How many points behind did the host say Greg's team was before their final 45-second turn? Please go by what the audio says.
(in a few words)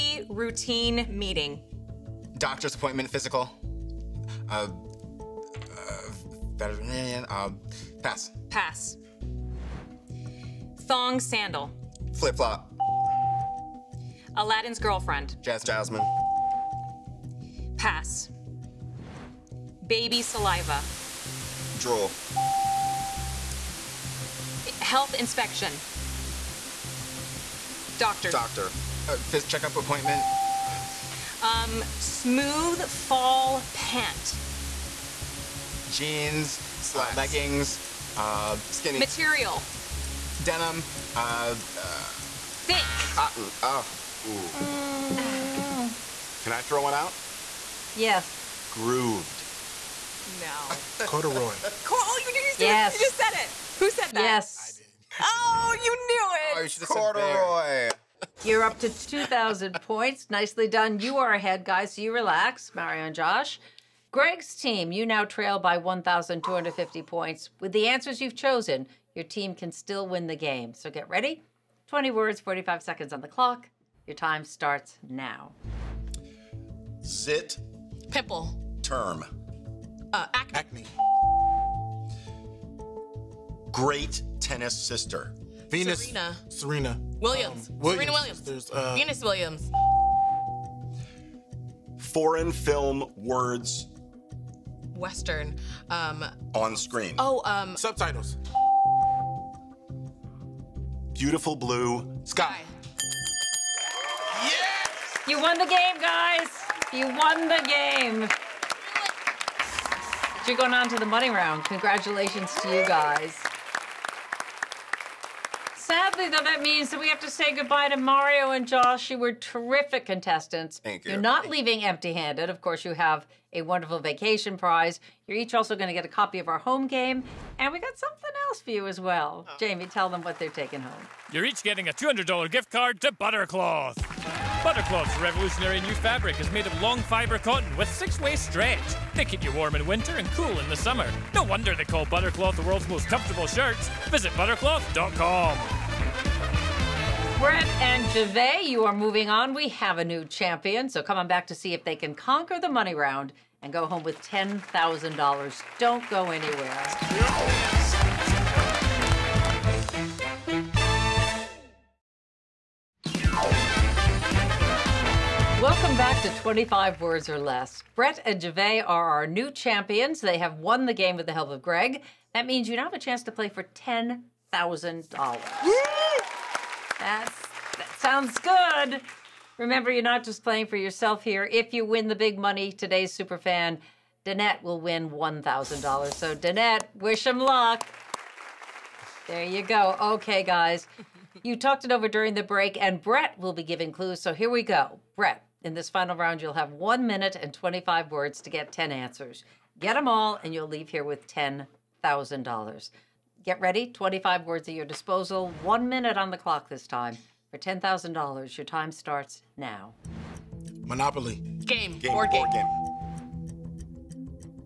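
1,250 points.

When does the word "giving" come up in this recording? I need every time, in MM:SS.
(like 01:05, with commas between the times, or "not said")
03:13.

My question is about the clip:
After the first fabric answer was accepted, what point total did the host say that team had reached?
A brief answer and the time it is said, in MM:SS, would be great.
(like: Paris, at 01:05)
2,000 points, at 00:58.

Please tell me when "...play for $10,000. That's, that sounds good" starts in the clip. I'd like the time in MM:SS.
02:53.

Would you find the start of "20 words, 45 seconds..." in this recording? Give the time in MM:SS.
01:11.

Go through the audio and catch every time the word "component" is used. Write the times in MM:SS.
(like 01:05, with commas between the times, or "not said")
not said.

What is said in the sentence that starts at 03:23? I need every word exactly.
Get ready, 25 words at your disposal, one minute on the clock this time.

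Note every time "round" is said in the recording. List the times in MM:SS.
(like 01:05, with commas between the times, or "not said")
01:51, 02:32, 03:16.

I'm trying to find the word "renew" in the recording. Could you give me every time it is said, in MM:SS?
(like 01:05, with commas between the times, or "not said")
not said.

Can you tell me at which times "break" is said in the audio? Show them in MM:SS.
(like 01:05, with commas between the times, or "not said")
03:12.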